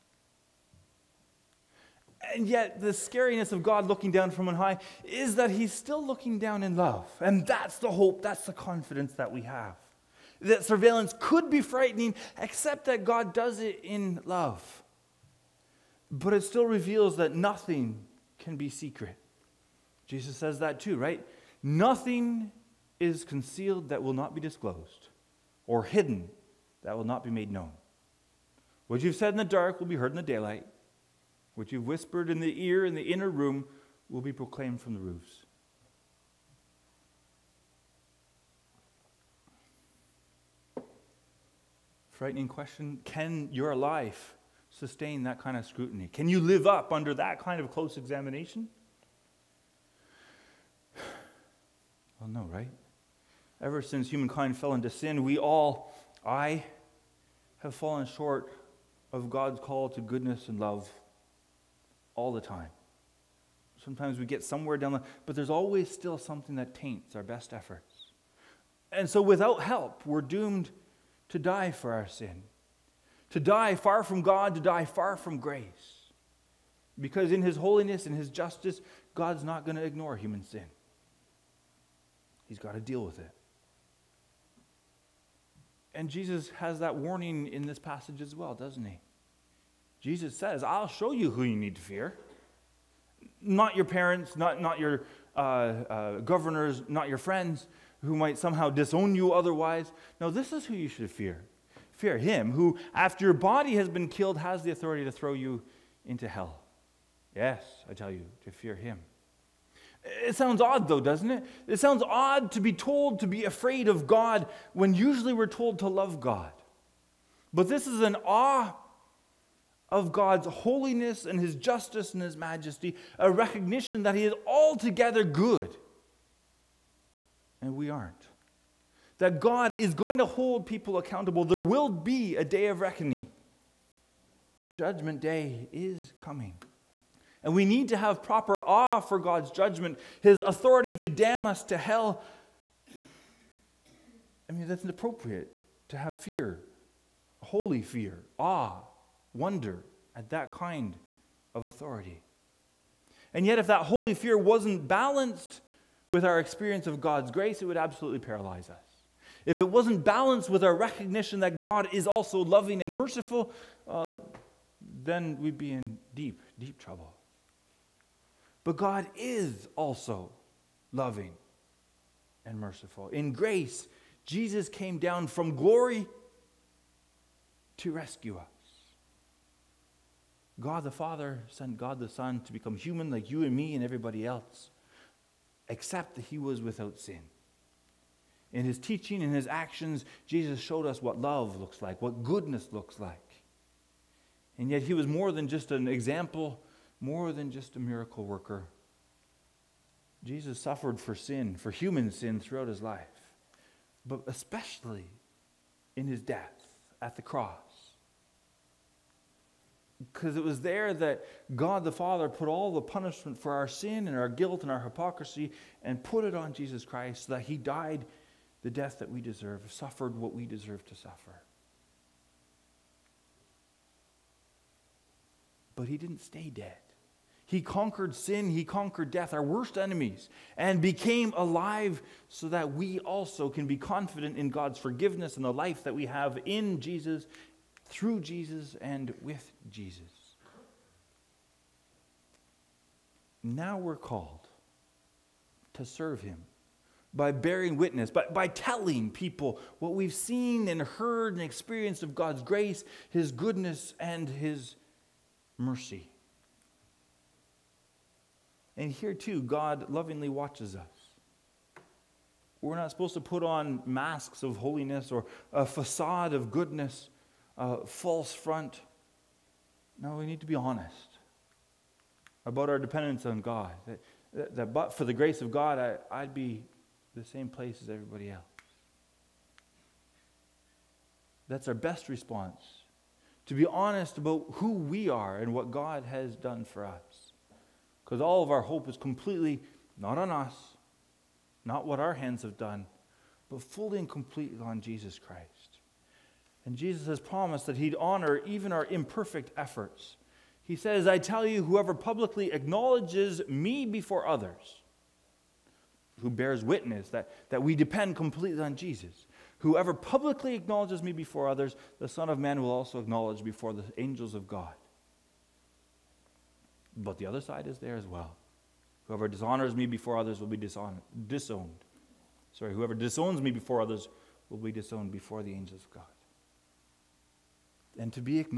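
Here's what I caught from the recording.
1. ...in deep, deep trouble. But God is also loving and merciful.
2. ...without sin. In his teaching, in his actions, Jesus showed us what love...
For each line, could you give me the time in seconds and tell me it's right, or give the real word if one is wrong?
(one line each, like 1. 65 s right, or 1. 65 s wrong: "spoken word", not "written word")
1. 165 s right
2. 186 s right.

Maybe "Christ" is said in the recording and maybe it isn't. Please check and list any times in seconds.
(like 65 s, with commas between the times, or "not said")
216 s, 295 s.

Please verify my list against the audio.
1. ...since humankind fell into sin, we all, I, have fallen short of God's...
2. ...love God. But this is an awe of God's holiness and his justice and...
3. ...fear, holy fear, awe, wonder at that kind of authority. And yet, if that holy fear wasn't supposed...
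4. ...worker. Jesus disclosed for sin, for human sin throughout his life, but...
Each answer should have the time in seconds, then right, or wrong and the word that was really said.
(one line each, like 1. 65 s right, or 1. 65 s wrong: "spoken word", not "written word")
1. 53 s right
2. 115 s right
3. 146 s wrong: "balanced", not "supposed"
4. 198 s wrong: "suffered", not "disclosed".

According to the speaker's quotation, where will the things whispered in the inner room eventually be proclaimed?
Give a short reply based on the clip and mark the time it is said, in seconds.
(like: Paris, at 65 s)
From the roofs, at 34 s.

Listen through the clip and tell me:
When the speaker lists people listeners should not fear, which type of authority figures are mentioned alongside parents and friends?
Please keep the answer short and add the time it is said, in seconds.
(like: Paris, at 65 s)
Governors, at 96 s.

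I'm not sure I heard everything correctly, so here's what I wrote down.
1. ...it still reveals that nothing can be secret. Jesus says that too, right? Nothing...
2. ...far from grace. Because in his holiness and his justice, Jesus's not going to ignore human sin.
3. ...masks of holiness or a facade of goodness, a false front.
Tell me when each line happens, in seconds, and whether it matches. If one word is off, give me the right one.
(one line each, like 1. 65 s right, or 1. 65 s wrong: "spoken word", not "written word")
1. 16 s right
2. 74 s wrong: "God", not "Jesus"
3. 263 s right.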